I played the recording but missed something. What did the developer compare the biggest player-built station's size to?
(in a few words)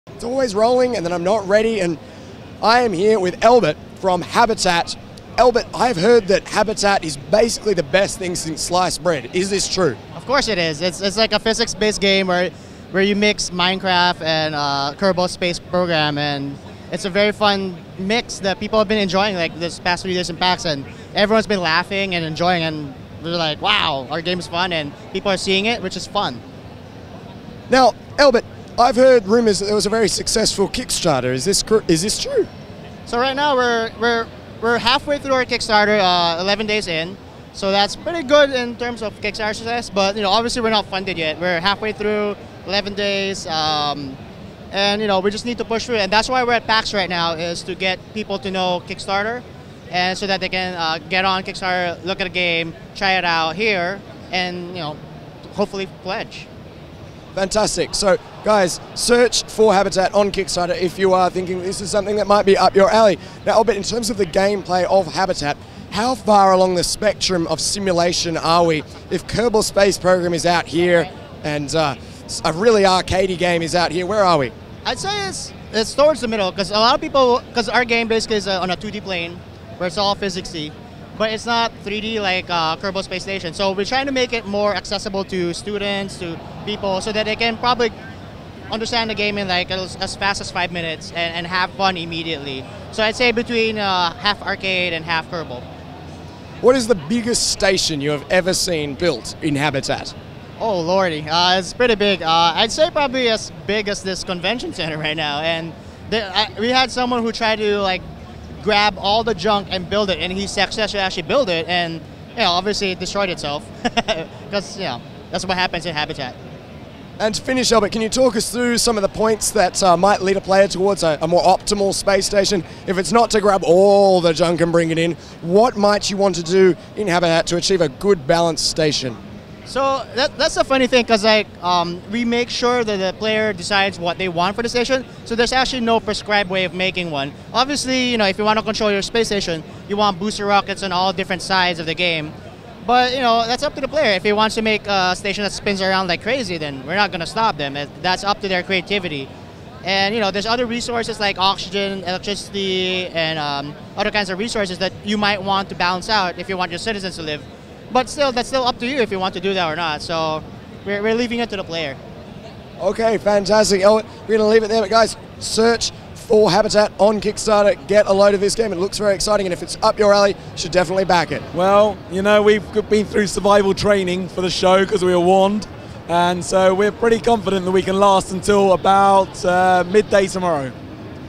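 this convention center.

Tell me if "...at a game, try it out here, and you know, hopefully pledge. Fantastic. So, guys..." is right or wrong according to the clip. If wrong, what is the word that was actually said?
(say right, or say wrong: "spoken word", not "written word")
right.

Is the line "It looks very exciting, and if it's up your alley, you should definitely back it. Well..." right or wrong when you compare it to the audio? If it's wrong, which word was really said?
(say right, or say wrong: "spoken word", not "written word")
right.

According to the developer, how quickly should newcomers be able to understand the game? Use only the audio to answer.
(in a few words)
5 minutes.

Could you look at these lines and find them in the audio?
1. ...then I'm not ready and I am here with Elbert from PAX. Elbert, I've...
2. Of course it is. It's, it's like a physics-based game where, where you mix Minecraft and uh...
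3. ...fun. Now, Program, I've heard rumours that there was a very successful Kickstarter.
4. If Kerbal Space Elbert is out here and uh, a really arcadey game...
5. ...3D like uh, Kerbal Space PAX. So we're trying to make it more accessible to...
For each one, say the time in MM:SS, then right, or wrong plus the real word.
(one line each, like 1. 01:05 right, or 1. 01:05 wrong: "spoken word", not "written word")
1. 00:01 wrong: "Habitat", not "PAX"
2. 00:10 right
3. 00:26 wrong: "Elbert", not "Program"
4. 01:09 wrong: "Program", not "Elbert"
5. 01:21 wrong: "Station", not "PAX".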